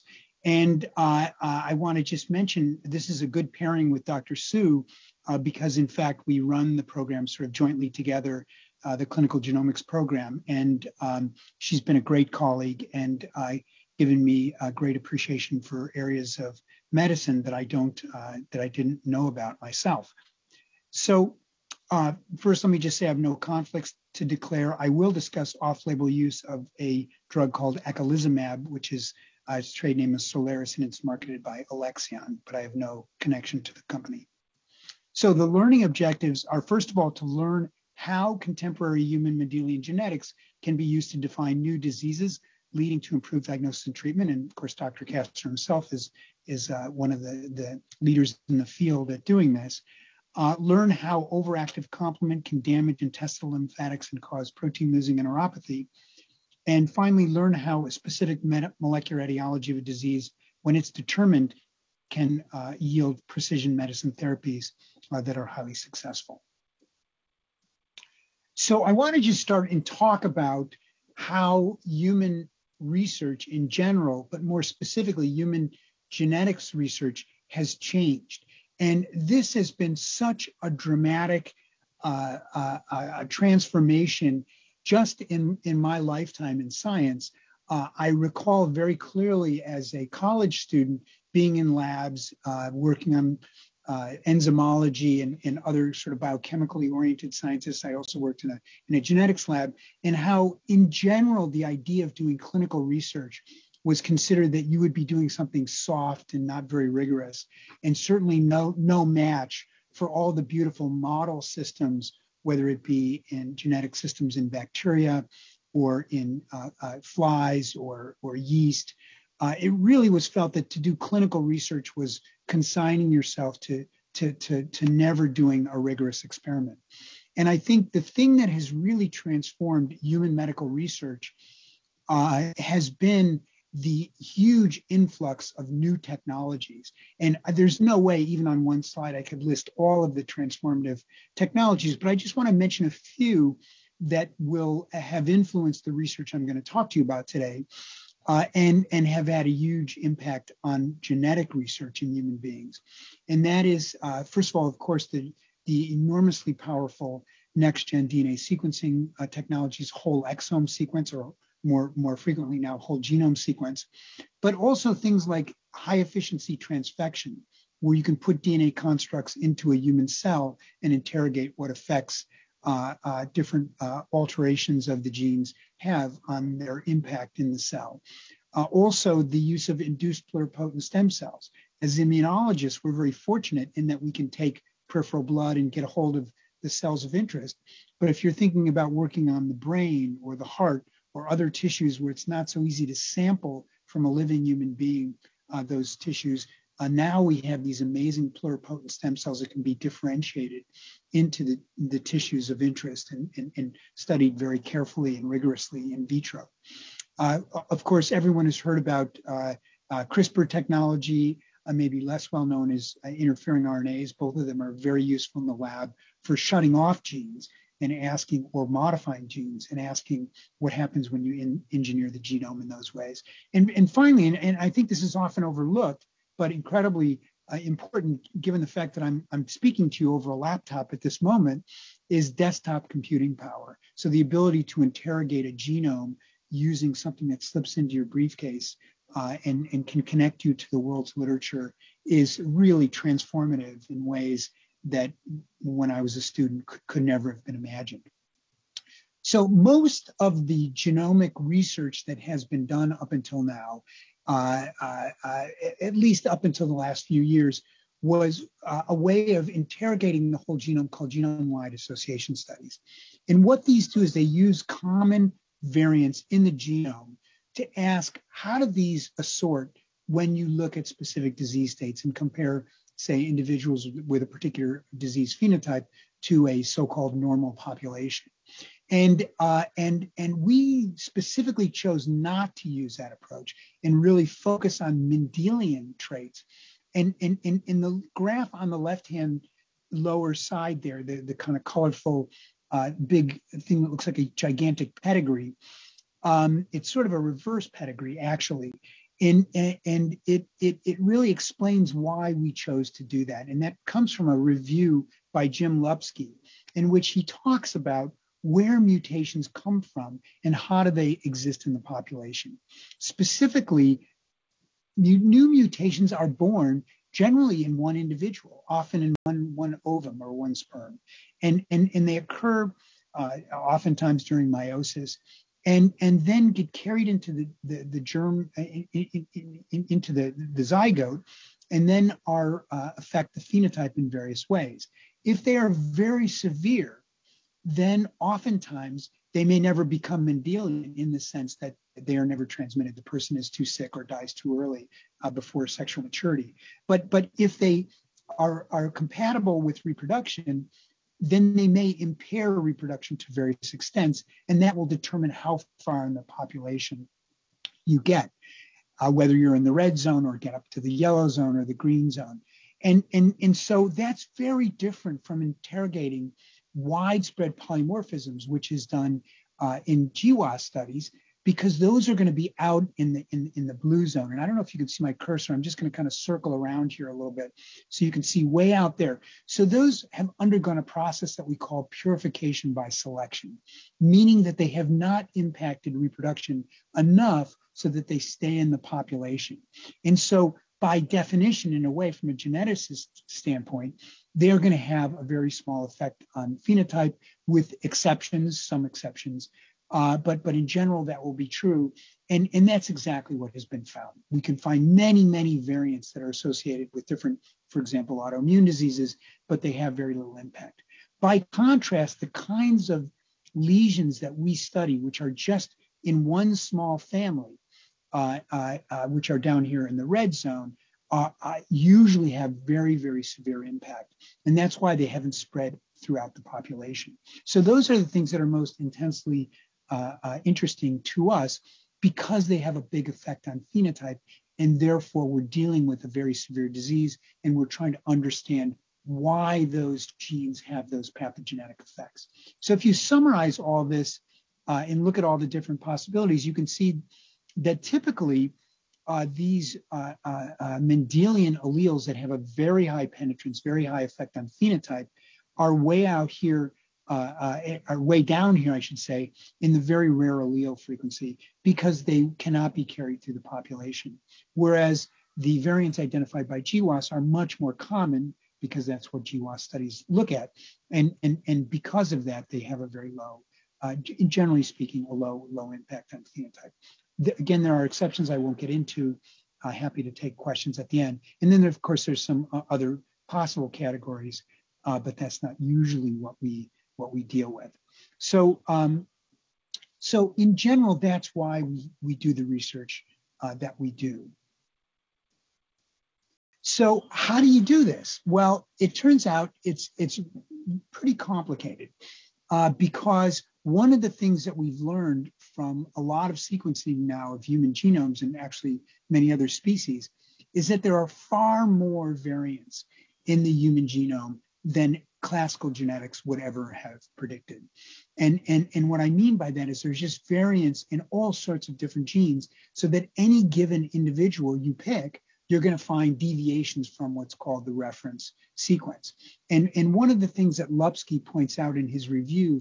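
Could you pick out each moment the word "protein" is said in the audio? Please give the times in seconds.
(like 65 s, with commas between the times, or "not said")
54 s.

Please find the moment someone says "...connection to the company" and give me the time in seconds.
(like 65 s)
33 s.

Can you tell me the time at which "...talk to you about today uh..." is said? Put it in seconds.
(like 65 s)
146 s.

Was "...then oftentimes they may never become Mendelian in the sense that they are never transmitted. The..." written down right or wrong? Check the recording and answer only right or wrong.
right.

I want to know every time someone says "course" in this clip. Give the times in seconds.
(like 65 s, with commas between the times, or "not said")
44 s, 154 s, 207 s, 481 s.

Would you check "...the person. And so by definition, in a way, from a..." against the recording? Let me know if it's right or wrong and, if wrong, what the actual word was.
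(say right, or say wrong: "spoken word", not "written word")
wrong: "population", not "person".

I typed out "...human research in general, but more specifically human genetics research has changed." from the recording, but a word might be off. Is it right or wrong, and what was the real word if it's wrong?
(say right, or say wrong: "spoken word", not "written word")
right.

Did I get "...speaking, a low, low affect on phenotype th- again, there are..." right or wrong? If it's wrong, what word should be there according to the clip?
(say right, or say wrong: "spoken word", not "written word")
wrong: "impact", not "affect".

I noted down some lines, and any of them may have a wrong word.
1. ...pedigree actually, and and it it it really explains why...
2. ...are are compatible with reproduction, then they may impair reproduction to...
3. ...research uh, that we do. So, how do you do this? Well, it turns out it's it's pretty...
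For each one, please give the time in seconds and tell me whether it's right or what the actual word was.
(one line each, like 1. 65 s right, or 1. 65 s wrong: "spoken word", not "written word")
1. 297 s right
2. 348 s right
3. 492 s right.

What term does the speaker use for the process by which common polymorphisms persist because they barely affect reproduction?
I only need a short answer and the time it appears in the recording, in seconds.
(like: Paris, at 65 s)
purification by selection, at 381 s.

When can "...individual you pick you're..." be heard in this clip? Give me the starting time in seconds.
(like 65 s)
523 s.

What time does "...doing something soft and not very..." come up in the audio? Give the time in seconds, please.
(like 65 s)
105 s.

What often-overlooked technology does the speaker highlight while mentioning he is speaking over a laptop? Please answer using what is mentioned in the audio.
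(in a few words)
desktop computing power.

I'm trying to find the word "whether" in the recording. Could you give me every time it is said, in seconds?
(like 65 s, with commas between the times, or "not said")
112 s, 359 s.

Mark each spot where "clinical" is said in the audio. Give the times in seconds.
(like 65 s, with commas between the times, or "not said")
9 s, 102 s, 120 s.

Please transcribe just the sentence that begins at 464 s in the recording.
Whereas the variants identified by GWAS are much more common because that's what GWAS studies look at.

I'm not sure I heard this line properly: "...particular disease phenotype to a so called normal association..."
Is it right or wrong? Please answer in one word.
wrong.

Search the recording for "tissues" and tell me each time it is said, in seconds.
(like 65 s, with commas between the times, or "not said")
191 s, 195 s, 201 s.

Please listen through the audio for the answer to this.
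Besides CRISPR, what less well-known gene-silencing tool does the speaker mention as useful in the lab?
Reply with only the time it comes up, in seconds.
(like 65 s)
213 s.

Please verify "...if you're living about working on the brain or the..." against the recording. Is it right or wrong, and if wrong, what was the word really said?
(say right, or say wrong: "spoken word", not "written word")
wrong: "thinking", not "living".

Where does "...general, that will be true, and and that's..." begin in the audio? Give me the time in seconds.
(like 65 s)
400 s.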